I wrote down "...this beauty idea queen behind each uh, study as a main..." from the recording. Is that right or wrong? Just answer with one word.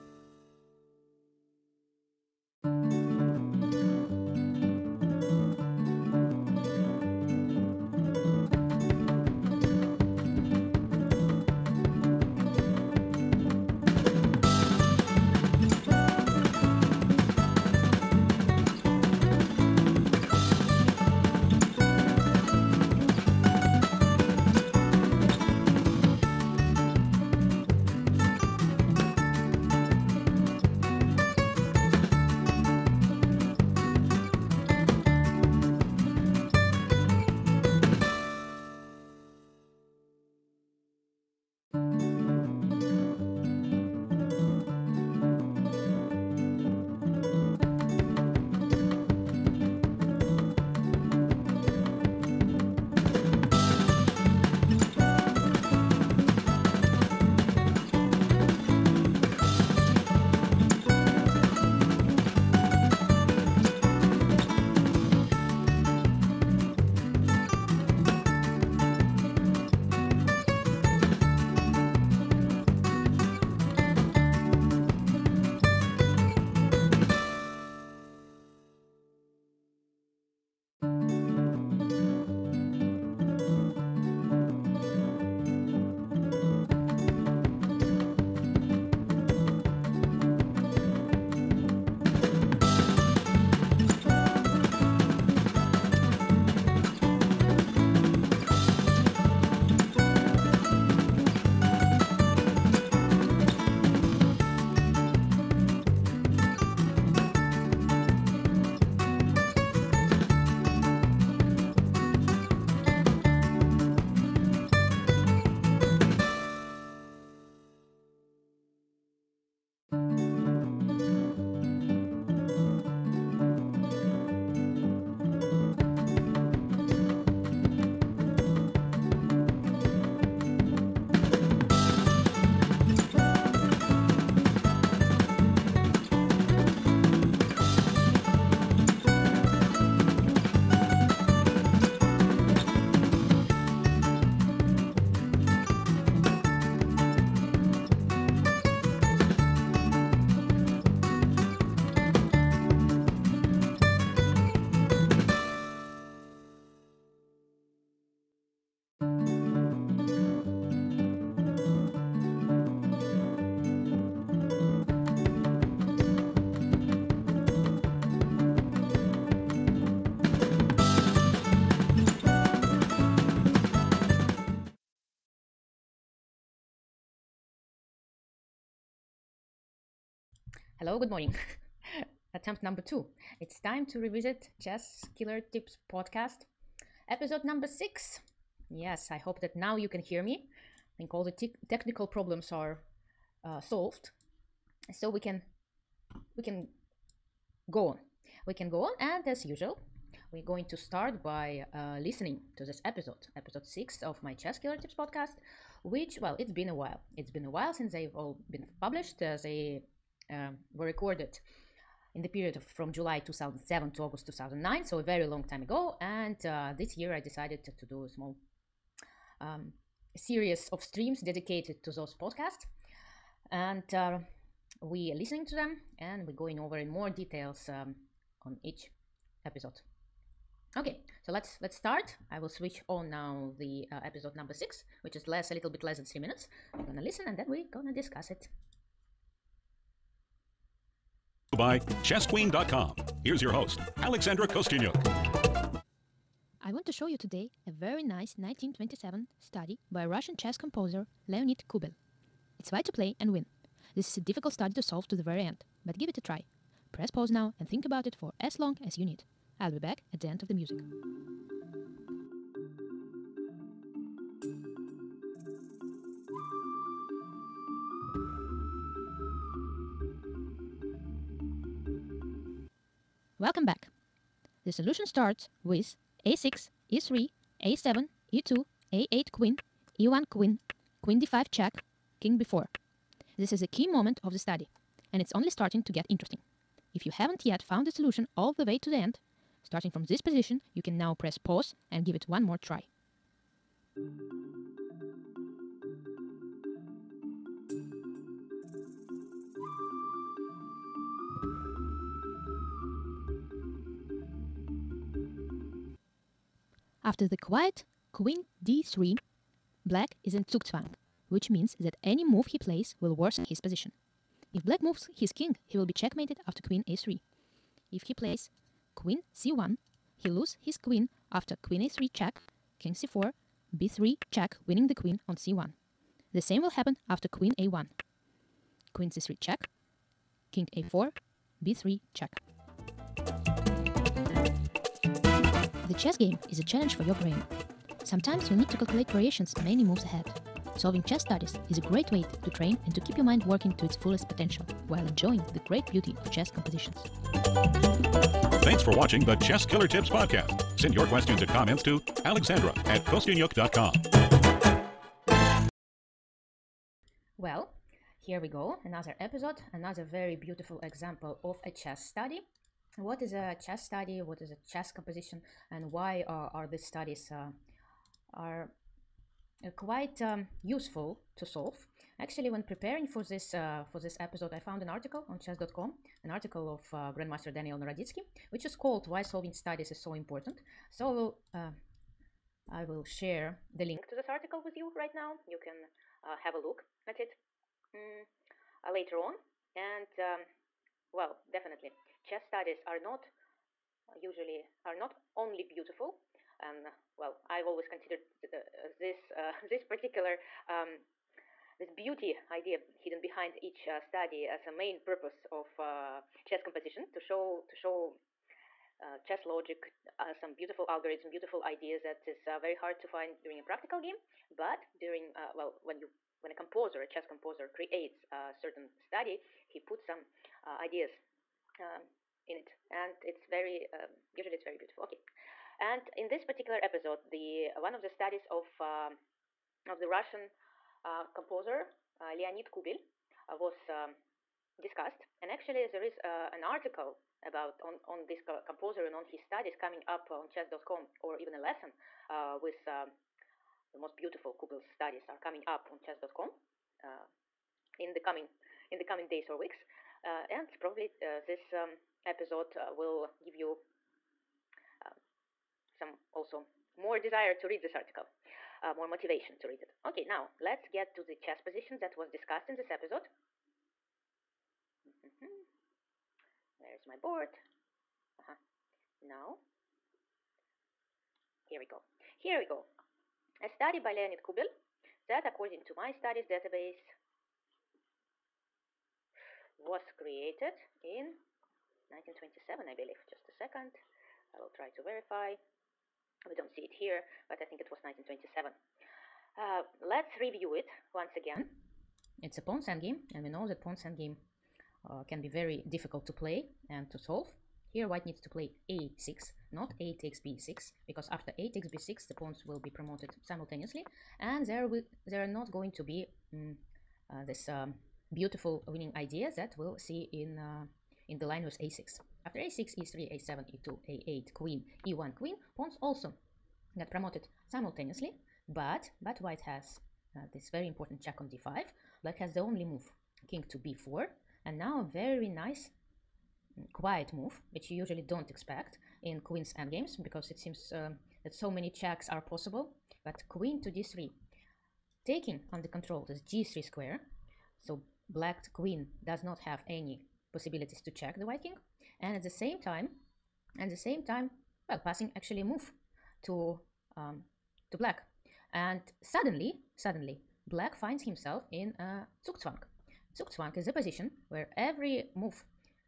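wrong.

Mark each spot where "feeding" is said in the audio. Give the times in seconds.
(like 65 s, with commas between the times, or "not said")
not said.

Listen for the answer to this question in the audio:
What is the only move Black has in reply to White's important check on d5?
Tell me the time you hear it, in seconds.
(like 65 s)
523 s.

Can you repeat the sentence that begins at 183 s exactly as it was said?
It's time to revisit Chess Killer Tips podcast, episode number six.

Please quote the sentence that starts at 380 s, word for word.
So I will, uh, I will share the link to this article with you right now.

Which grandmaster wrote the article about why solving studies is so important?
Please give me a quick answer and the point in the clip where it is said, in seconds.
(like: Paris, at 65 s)
Daniel Naroditsky, at 377 s.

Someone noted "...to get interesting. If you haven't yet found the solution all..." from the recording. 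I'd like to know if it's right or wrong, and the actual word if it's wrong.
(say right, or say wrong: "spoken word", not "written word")
right.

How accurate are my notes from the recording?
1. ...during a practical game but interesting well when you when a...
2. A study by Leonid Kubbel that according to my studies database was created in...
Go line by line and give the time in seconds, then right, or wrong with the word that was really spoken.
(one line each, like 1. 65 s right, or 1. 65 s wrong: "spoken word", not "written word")
1. 413 s wrong: "during", not "interesting"
2. 473 s right.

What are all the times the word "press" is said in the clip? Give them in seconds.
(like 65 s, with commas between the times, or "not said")
256 s, 291 s.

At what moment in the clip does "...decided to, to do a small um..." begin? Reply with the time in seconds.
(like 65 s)
217 s.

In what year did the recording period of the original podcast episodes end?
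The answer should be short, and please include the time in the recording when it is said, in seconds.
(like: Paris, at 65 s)
2009, at 214 s.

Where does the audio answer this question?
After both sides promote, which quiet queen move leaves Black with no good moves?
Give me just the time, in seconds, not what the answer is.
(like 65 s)
308 s.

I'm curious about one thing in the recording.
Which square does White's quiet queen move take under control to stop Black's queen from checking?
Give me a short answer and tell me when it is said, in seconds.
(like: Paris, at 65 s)
g3, at 536 s.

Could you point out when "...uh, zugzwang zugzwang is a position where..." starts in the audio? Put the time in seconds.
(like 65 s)
552 s.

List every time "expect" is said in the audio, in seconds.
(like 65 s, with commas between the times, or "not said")
528 s.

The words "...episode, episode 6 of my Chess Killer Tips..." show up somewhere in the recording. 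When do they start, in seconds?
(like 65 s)
202 s.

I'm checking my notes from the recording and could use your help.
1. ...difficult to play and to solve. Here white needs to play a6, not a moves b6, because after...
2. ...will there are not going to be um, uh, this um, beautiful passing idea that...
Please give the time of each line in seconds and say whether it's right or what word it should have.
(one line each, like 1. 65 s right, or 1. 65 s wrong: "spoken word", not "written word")
1. 495 s wrong: "takes", not "moves"
2. 504 s wrong: "winning", not "passing".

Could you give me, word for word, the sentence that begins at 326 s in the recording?
The same will happen after queen a1.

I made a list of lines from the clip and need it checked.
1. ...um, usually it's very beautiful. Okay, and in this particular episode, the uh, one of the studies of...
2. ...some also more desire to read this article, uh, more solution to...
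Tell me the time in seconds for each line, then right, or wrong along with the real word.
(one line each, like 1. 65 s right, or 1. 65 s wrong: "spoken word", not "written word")
1. 423 s right
2. 455 s wrong: "motivation", not "solution".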